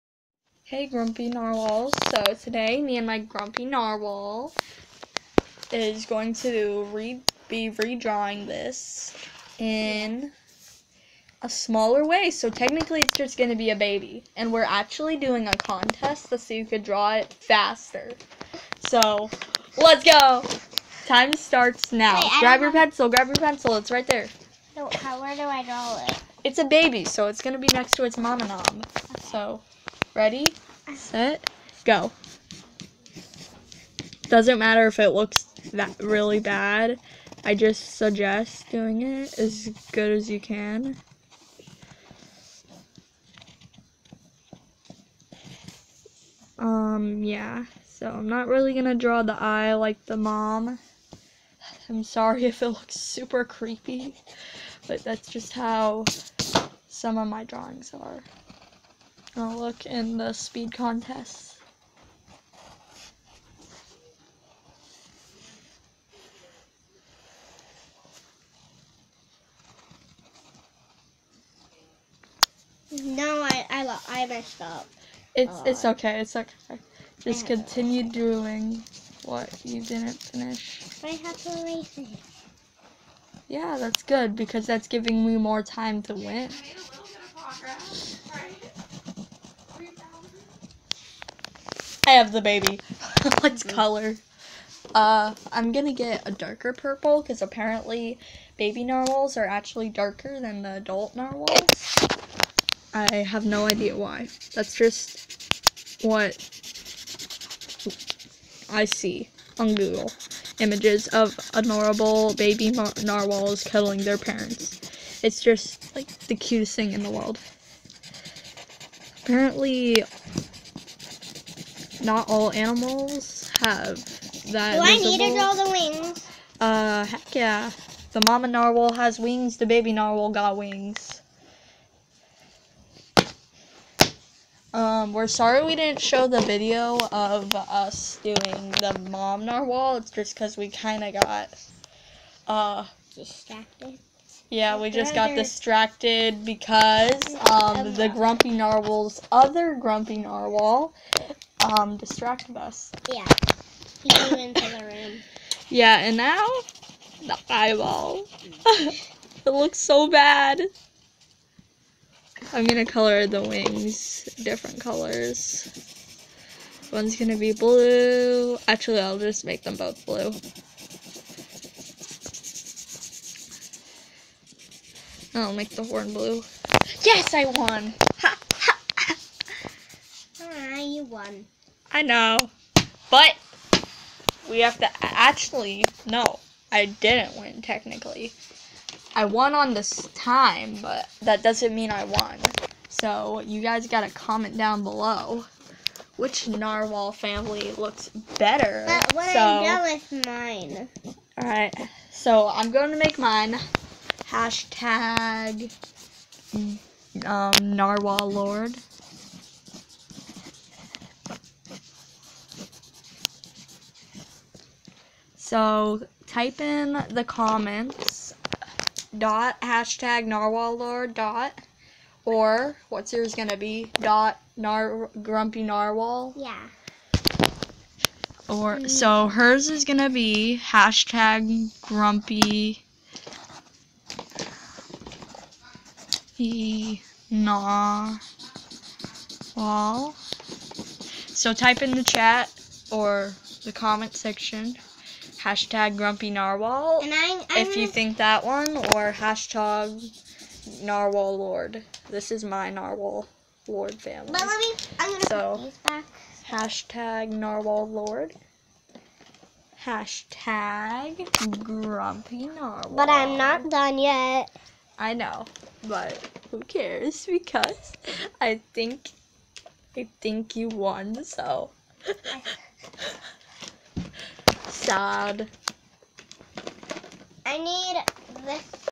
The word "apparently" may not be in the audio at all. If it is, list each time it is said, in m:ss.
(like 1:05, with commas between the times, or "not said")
1:37, 1:59.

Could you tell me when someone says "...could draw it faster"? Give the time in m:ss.
0:16.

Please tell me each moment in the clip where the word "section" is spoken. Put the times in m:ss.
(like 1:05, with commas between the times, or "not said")
4:04.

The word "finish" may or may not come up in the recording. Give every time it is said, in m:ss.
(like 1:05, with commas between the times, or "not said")
1:20.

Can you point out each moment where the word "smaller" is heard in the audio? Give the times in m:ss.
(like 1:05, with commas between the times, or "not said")
0:11.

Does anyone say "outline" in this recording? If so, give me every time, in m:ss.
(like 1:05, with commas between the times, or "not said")
not said.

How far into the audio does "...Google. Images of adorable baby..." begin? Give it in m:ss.
1:49.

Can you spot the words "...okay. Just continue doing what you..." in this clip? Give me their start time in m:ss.
1:16.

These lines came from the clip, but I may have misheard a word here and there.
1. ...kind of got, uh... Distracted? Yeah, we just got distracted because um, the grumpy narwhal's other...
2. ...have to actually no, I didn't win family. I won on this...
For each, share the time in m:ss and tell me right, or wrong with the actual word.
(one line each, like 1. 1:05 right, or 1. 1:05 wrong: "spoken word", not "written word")
1. 2:20 right
2. 3:04 wrong: "technically", not "family".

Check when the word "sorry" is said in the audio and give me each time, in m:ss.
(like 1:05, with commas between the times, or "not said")
0:52, 2:15.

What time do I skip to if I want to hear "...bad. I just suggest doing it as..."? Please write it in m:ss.
0:36.